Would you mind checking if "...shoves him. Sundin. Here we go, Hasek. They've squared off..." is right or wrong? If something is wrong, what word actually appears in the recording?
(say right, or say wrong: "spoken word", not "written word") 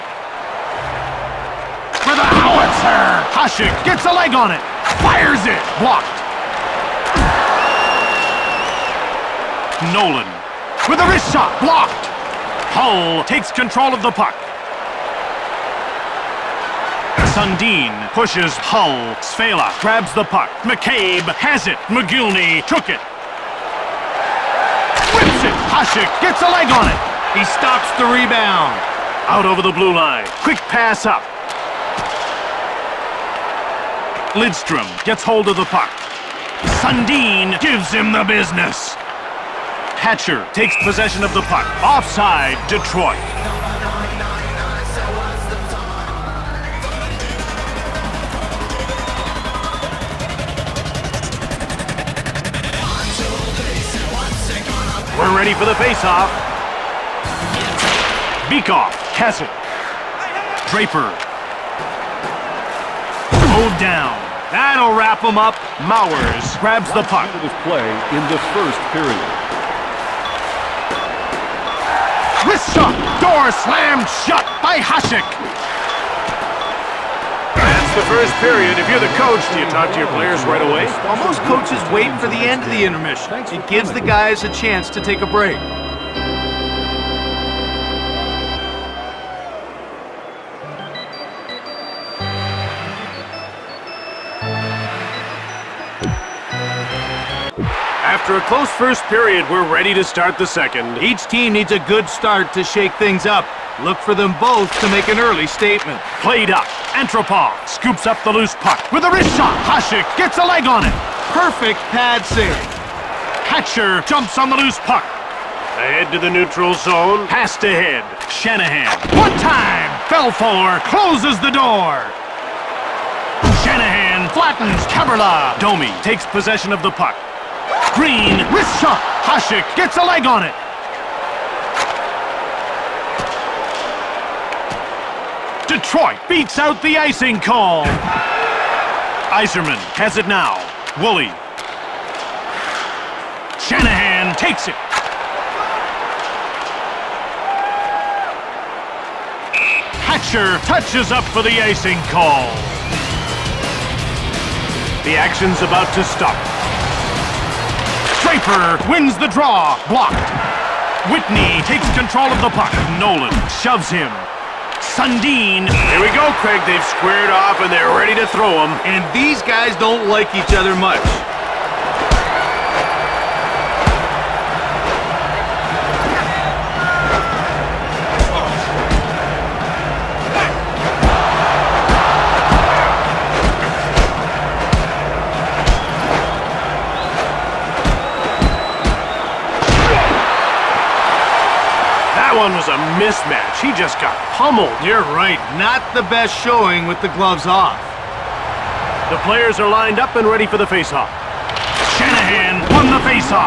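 wrong: "Craig", not "Hasek".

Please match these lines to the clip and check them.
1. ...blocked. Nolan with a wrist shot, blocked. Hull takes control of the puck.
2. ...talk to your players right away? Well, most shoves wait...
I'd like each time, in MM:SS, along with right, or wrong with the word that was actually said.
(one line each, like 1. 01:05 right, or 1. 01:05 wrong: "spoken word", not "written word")
1. 00:05 right
2. 01:19 wrong: "coaches", not "shoves".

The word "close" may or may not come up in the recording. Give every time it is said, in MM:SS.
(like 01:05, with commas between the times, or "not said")
01:38, 02:00.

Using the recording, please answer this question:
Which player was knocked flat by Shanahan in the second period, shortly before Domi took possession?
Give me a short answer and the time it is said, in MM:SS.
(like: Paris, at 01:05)
Kaberle, at 02:04.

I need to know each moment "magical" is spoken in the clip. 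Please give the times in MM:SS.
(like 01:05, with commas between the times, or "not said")
not said.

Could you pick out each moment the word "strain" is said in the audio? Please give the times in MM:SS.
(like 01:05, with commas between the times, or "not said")
not said.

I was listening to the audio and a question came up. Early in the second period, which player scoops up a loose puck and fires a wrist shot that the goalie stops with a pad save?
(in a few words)
Antropov.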